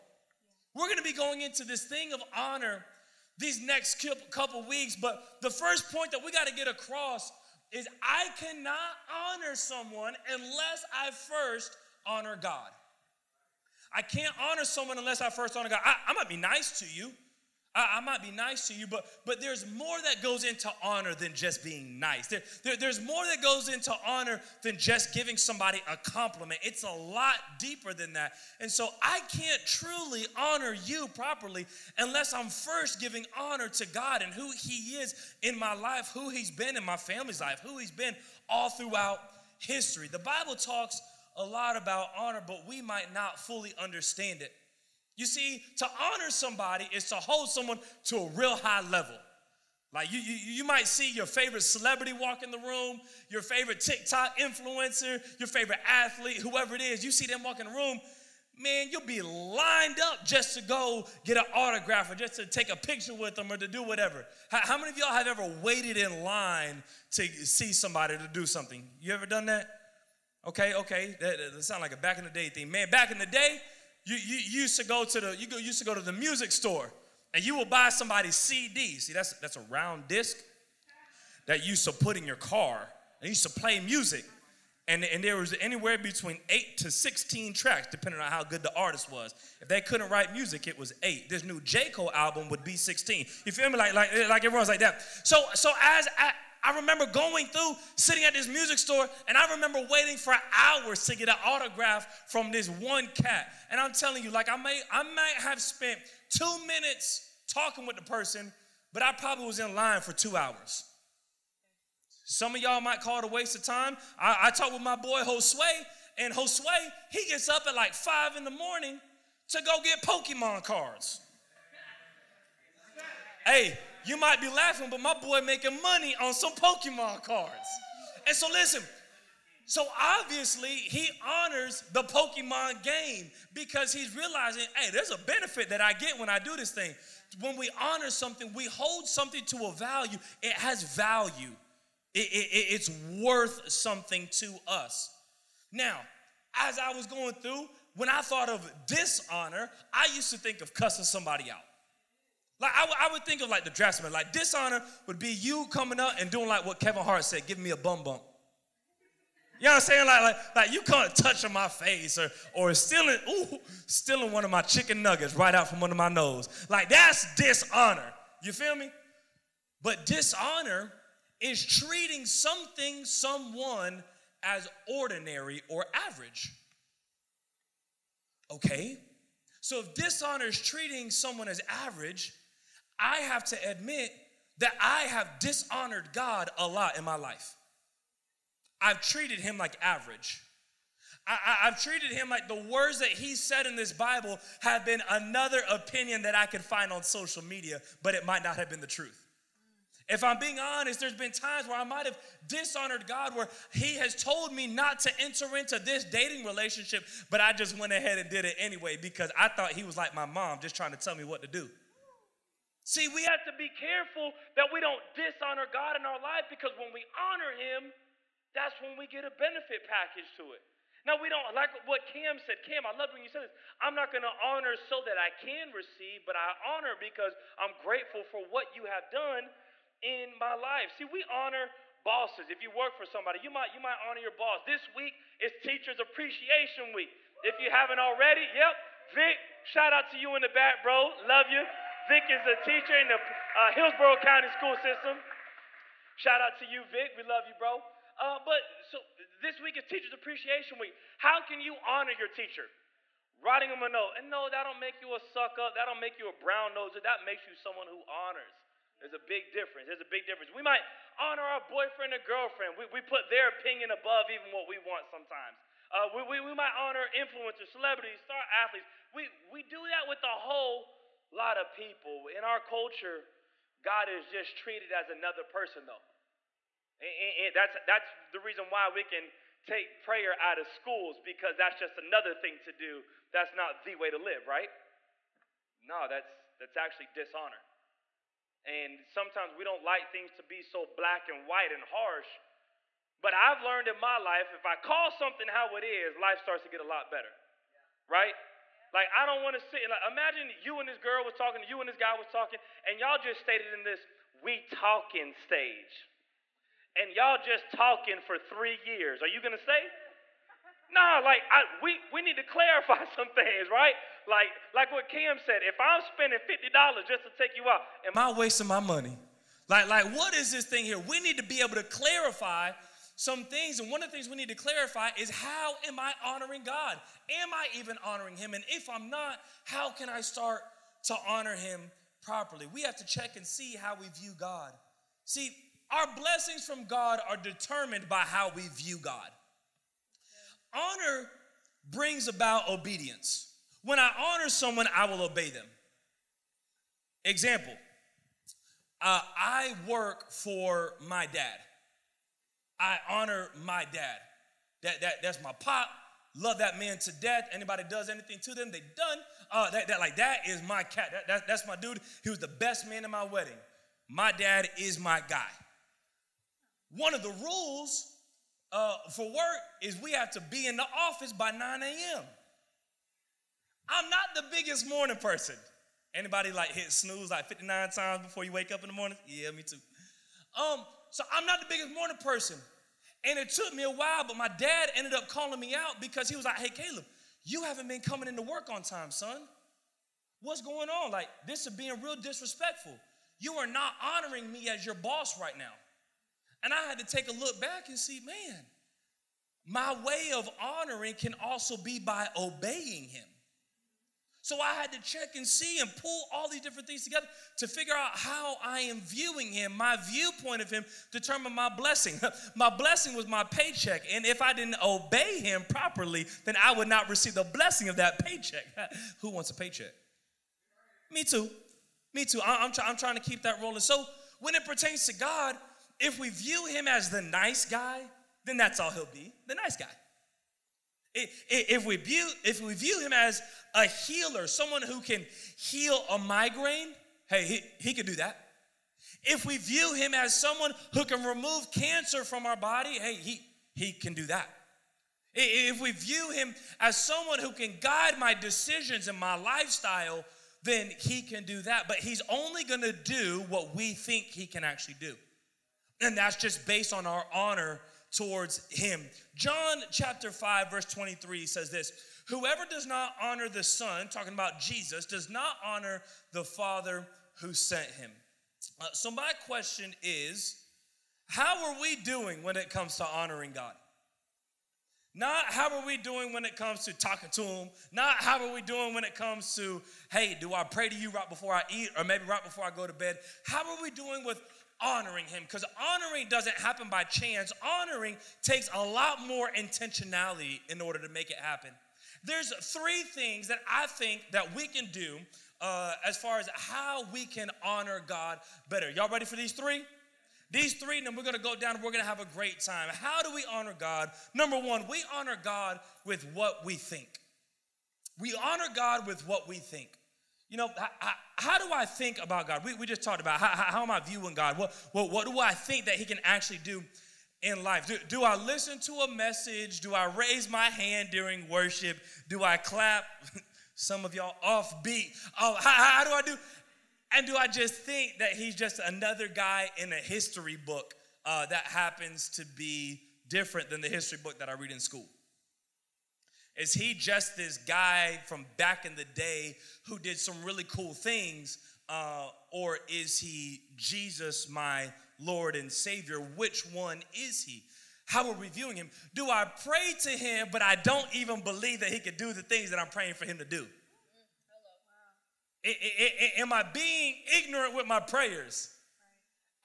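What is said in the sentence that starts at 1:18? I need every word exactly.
See, that's that's a round disc that you used to put in your car and you used to play music.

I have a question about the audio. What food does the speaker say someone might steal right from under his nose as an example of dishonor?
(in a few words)
Chicken nuggets.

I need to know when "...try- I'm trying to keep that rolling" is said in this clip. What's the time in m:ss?
7:02.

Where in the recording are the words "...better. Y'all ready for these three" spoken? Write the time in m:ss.
8:18.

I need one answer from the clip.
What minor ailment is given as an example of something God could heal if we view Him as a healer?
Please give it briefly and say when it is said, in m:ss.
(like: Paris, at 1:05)
Migraine, at 7:16.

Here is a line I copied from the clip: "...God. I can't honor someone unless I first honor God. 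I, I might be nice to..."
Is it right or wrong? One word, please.
right.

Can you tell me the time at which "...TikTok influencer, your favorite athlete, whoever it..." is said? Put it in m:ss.
0:53.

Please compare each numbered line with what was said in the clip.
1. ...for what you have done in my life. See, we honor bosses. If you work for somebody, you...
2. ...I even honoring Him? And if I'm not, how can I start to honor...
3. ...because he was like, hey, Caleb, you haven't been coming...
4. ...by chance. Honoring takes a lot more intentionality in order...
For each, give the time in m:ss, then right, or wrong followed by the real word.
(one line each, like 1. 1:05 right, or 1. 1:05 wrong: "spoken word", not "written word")
1. 3:48 right
2. 5:27 right
3. 6:26 right
4. 8:06 right.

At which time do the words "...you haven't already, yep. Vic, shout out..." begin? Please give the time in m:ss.
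3:57.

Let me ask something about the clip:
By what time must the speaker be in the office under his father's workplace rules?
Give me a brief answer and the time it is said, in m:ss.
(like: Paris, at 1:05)
9 a.m., at 6:11.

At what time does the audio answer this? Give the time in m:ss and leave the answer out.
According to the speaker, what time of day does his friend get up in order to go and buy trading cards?
1:57.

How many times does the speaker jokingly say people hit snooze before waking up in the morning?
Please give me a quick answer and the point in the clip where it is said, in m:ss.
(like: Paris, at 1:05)
59, at 6:17.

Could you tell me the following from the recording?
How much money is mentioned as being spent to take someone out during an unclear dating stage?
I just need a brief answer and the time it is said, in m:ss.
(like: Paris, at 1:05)
$50, at 5:16.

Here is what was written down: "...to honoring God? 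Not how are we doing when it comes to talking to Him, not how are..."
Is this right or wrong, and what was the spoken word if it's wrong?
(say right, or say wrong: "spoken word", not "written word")
right.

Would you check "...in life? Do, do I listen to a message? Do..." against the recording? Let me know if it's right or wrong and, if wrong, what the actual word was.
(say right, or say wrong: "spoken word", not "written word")
right.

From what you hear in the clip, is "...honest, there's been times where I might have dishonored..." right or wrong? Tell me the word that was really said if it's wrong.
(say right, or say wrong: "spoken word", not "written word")
right.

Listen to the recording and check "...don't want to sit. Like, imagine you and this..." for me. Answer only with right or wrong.
right.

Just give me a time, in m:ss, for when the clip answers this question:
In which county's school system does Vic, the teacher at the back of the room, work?
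4:03.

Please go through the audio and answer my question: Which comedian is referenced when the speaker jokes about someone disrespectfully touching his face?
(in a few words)
Kevin Hart.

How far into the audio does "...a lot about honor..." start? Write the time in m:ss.
0:41.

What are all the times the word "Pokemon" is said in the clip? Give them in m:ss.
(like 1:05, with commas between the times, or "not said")
2:00, 2:06, 2:12.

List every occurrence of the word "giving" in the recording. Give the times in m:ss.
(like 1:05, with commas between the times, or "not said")
0:25, 0:33, 2:37.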